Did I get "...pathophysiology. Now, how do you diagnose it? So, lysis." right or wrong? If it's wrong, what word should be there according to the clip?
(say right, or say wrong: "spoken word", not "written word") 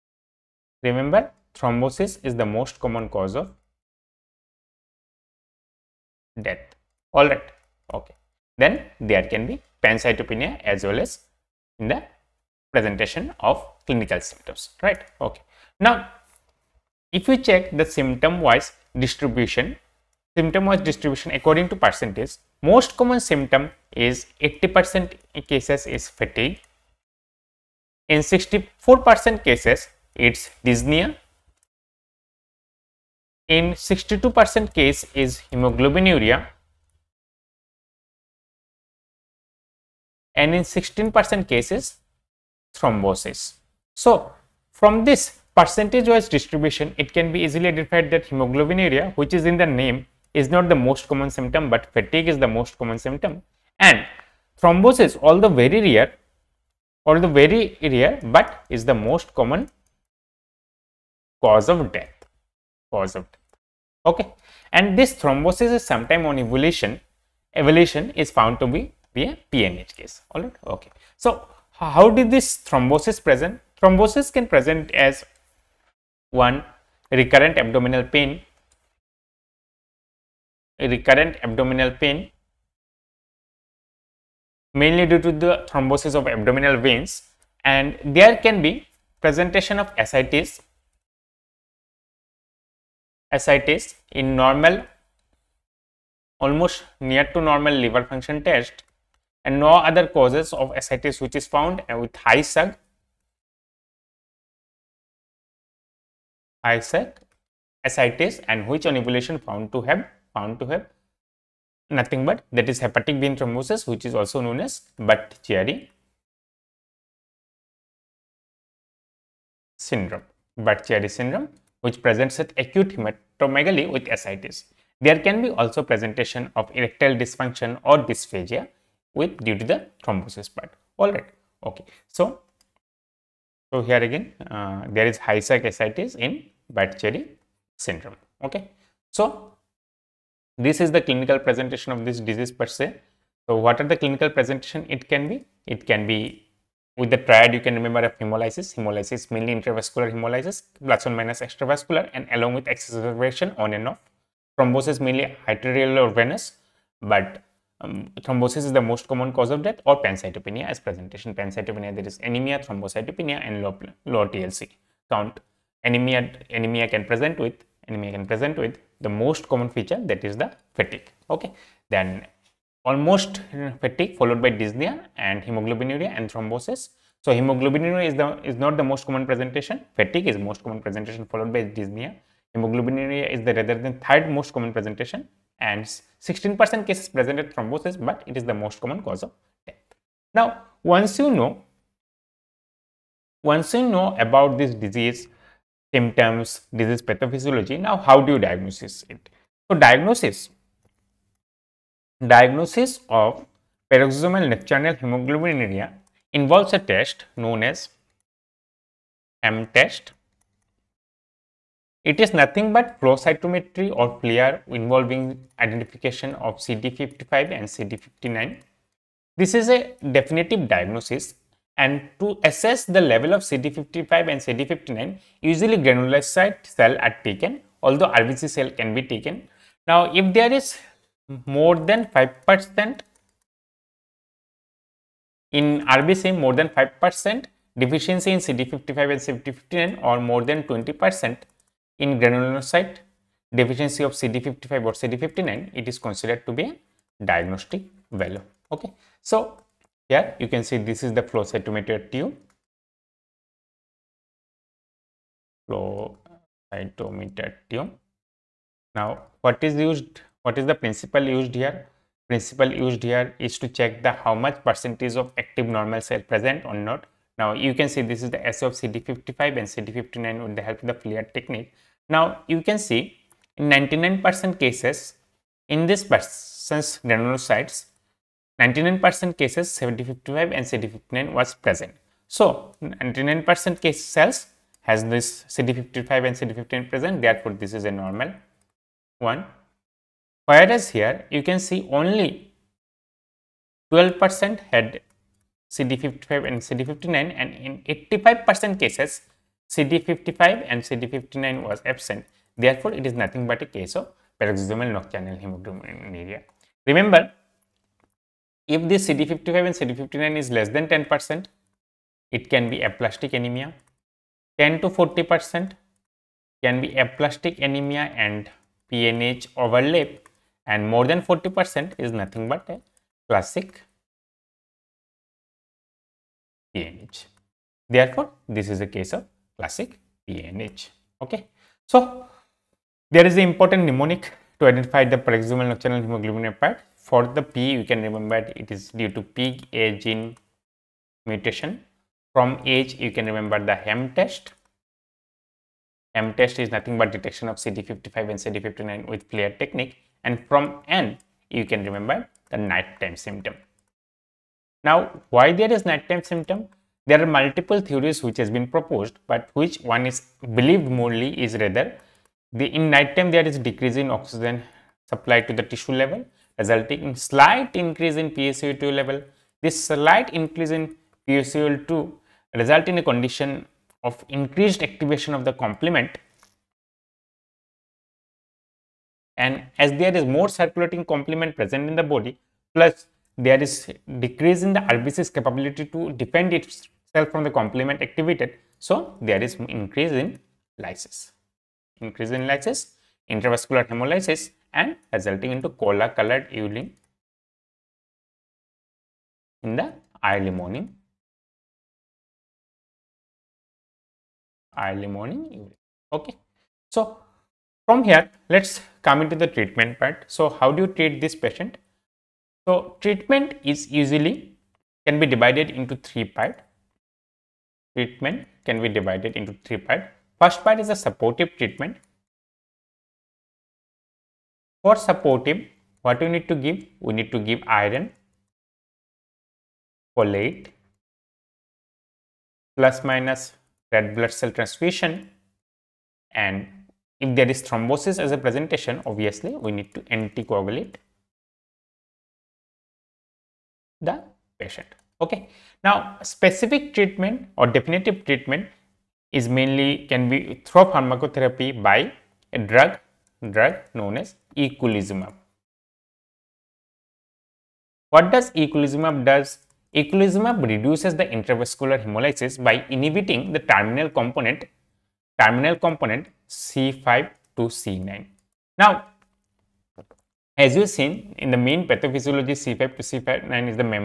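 wrong: "diagnosis", not "lysis".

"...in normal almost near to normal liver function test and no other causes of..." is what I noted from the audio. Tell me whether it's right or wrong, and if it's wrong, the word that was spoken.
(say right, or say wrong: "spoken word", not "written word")
right.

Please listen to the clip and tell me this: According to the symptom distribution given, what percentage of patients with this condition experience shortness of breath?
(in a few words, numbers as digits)
64%.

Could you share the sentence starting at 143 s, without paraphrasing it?
So what are the clinical presentation it can be?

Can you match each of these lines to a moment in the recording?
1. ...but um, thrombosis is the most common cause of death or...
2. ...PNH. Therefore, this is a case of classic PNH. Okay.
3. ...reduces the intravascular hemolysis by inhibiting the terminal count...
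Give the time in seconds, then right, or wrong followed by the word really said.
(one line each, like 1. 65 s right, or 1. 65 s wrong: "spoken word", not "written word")
1. 157 s right
2. 326 s right
3. 460 s wrong: "component", not "count".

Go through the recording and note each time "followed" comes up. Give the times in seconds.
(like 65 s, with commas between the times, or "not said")
174 s, 181 s.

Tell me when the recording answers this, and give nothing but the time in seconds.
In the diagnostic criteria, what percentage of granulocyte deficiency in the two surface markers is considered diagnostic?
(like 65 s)
240 s.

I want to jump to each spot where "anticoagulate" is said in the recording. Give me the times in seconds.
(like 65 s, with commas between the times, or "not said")
440 s.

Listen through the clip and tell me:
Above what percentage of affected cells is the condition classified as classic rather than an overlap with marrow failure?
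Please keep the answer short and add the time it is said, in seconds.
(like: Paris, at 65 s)
40%, at 320 s.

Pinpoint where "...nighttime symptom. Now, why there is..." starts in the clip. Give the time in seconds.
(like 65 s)
352 s.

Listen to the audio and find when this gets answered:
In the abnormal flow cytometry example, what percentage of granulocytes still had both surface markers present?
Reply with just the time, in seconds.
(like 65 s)
293 s.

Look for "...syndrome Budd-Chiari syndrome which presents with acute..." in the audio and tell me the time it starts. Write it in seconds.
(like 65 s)
119 s.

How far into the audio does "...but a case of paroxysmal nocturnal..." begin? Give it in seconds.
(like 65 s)
303 s.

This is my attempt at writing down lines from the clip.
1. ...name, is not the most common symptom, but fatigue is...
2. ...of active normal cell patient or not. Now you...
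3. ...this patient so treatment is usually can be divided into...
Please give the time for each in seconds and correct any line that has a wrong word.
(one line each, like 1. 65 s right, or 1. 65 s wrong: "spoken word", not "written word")
1. 49 s right
2. 265 s wrong: "present", not "patient"
3. 411 s right.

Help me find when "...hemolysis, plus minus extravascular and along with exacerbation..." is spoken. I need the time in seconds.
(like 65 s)
150 s.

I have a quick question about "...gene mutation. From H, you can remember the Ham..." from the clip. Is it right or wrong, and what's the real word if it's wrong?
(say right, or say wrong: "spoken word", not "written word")
right.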